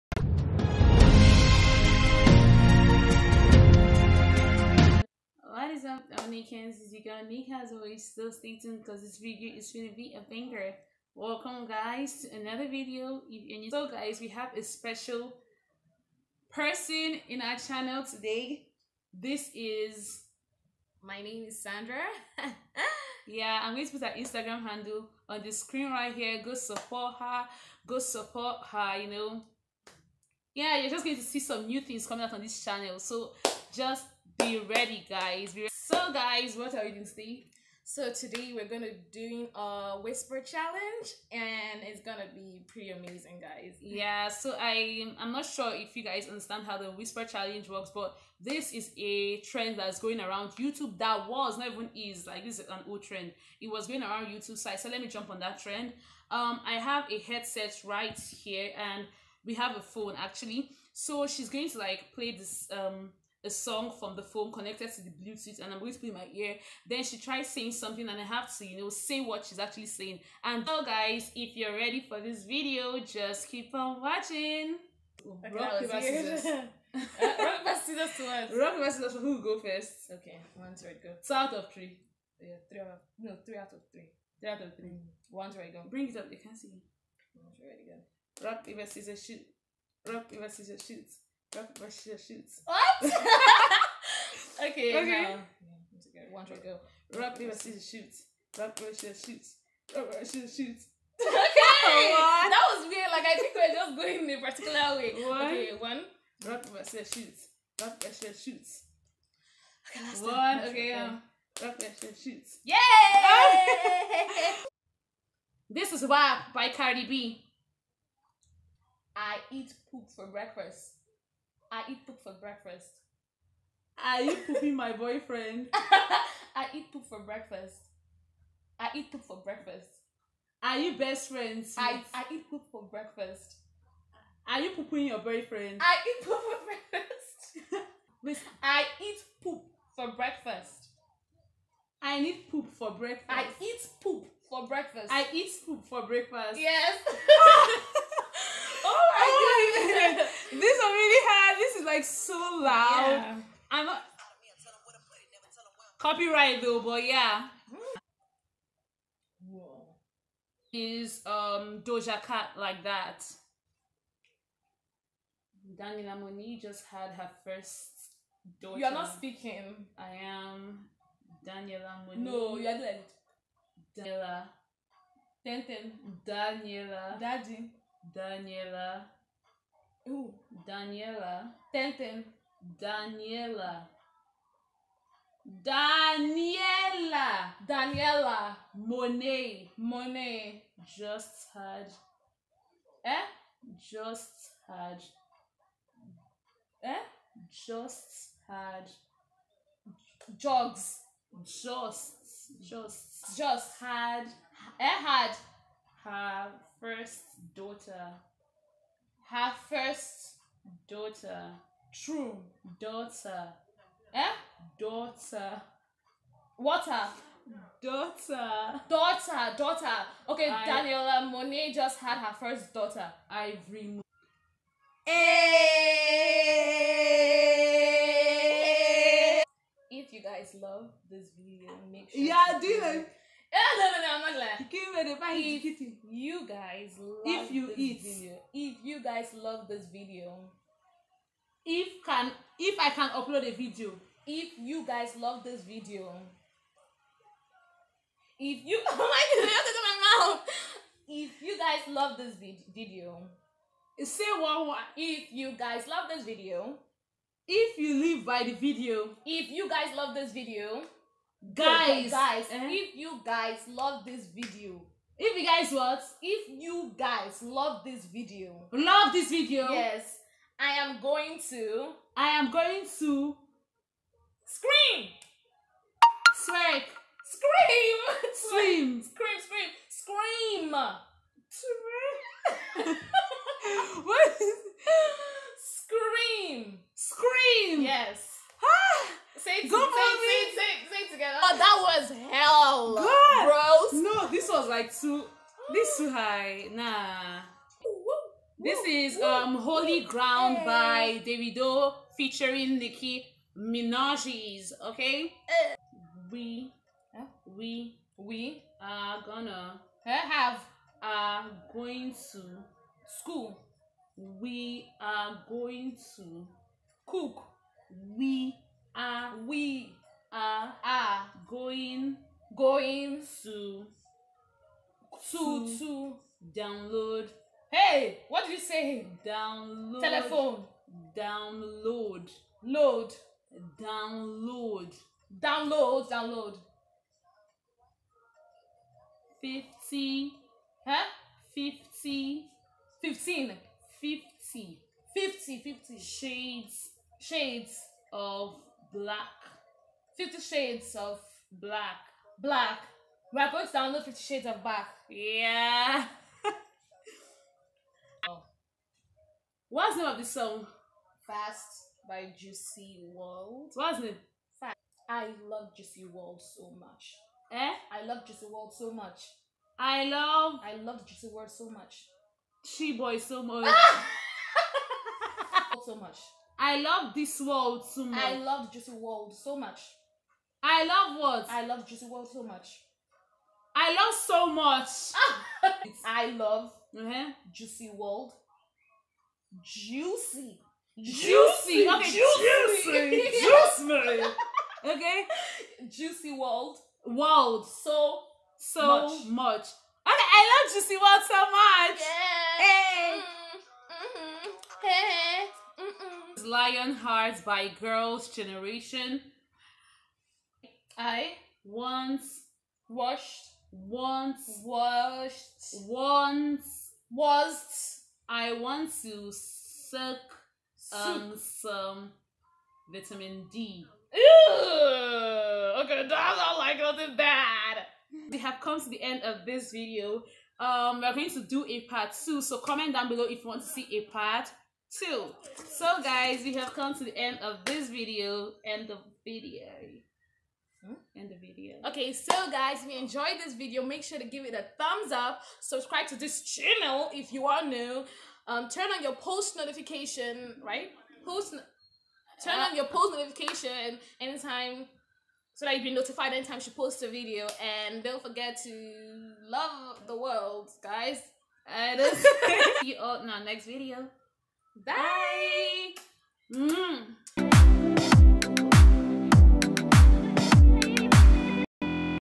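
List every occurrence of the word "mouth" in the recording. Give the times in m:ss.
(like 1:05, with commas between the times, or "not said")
4:10.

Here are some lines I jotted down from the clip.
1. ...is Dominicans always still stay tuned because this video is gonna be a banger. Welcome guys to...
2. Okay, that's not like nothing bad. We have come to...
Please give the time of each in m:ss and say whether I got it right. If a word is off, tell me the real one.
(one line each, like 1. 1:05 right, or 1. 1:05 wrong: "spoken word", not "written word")
1. 0:06 right
2. 7:05 right.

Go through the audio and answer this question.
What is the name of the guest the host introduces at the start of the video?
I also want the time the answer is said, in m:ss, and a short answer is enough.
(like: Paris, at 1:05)
Sandra, at 0:21.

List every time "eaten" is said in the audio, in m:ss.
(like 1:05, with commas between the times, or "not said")
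not said.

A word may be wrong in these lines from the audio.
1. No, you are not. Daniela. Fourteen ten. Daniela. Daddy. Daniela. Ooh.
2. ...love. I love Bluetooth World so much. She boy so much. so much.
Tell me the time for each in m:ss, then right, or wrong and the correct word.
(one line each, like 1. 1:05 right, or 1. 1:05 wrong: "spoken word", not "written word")
1. 2:52 wrong: "Ten", not "Fourteen"
2. 6:10 wrong: "Juicy", not "Bluetooth".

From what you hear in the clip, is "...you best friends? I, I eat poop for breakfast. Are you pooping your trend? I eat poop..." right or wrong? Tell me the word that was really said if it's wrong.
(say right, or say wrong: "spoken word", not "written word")
wrong: "boyfriend", not "trend".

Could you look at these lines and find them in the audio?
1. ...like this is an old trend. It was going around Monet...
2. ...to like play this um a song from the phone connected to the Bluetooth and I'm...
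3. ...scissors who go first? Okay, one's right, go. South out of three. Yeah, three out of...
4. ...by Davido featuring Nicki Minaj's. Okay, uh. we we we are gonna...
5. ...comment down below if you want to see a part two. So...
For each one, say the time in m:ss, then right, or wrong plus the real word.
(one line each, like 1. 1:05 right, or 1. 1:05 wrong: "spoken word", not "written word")
1. 0:52 wrong: "YouTube", not "Monet"
2. 1:01 right
3. 1:18 right
4. 5:00 right
5. 7:12 right.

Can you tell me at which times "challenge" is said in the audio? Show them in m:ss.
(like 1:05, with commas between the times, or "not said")
0:40, 0:47.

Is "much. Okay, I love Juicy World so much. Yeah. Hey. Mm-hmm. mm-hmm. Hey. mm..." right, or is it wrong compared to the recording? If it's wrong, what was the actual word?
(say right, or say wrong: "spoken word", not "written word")
right.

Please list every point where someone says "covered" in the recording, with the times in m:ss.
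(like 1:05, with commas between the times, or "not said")
not said.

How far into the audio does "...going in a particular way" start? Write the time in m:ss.
1:43.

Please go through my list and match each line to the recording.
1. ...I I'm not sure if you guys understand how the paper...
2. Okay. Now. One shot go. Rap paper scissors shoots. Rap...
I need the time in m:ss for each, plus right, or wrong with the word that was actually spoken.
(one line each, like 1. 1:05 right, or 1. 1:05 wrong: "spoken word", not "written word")
1. 0:44 wrong: "whisper", not "paper"
2. 1:35 right.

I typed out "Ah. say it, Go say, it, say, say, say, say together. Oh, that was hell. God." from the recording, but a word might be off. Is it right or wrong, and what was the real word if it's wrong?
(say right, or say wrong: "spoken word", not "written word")
right.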